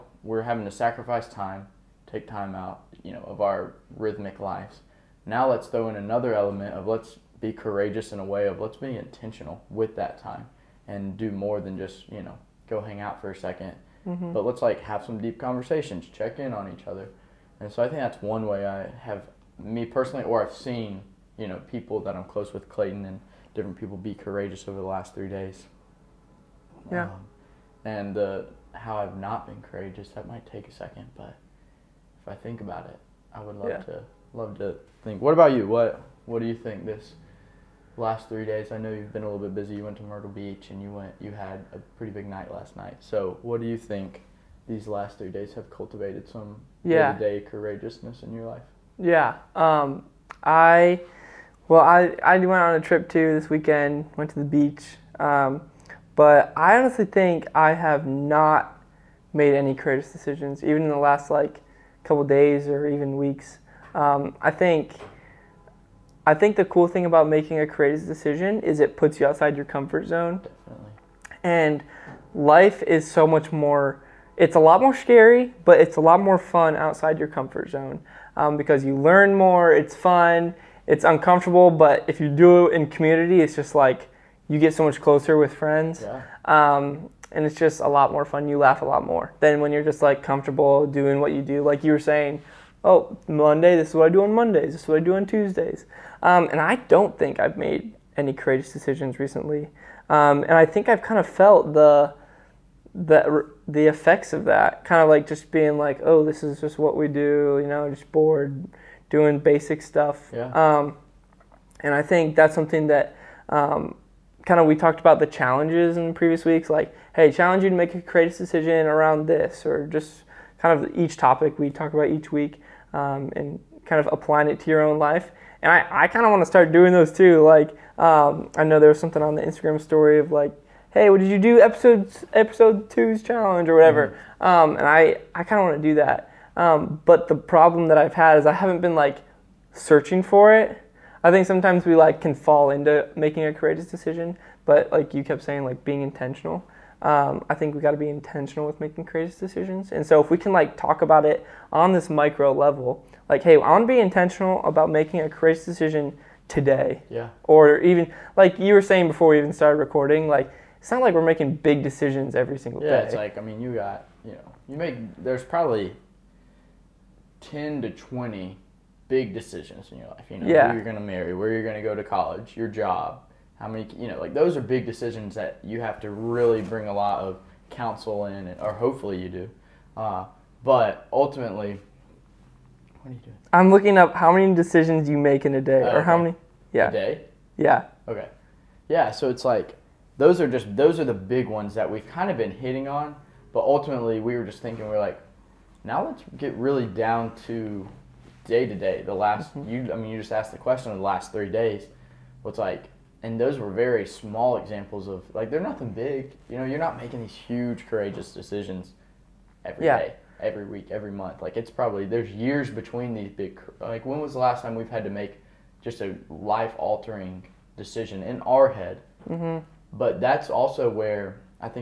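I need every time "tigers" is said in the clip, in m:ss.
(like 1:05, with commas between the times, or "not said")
not said.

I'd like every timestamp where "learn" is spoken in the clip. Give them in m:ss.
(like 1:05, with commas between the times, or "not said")
1:18.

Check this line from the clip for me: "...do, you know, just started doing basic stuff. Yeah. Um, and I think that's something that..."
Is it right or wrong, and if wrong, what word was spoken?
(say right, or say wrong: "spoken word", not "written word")
wrong: "bored", not "started".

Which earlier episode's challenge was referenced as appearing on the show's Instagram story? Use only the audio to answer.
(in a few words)
Episode 2.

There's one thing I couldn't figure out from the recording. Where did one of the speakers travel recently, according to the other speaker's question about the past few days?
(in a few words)
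Myrtle Beach.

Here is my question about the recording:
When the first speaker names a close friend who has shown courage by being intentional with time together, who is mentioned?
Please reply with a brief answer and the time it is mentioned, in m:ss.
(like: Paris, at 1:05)
Clayton, at 0:22.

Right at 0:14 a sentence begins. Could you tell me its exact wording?
But let's like have some deep conversations, check in on each other.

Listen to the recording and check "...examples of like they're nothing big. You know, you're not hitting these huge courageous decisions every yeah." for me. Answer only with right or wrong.
wrong.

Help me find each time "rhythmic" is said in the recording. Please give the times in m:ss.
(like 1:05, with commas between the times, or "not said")
0:03.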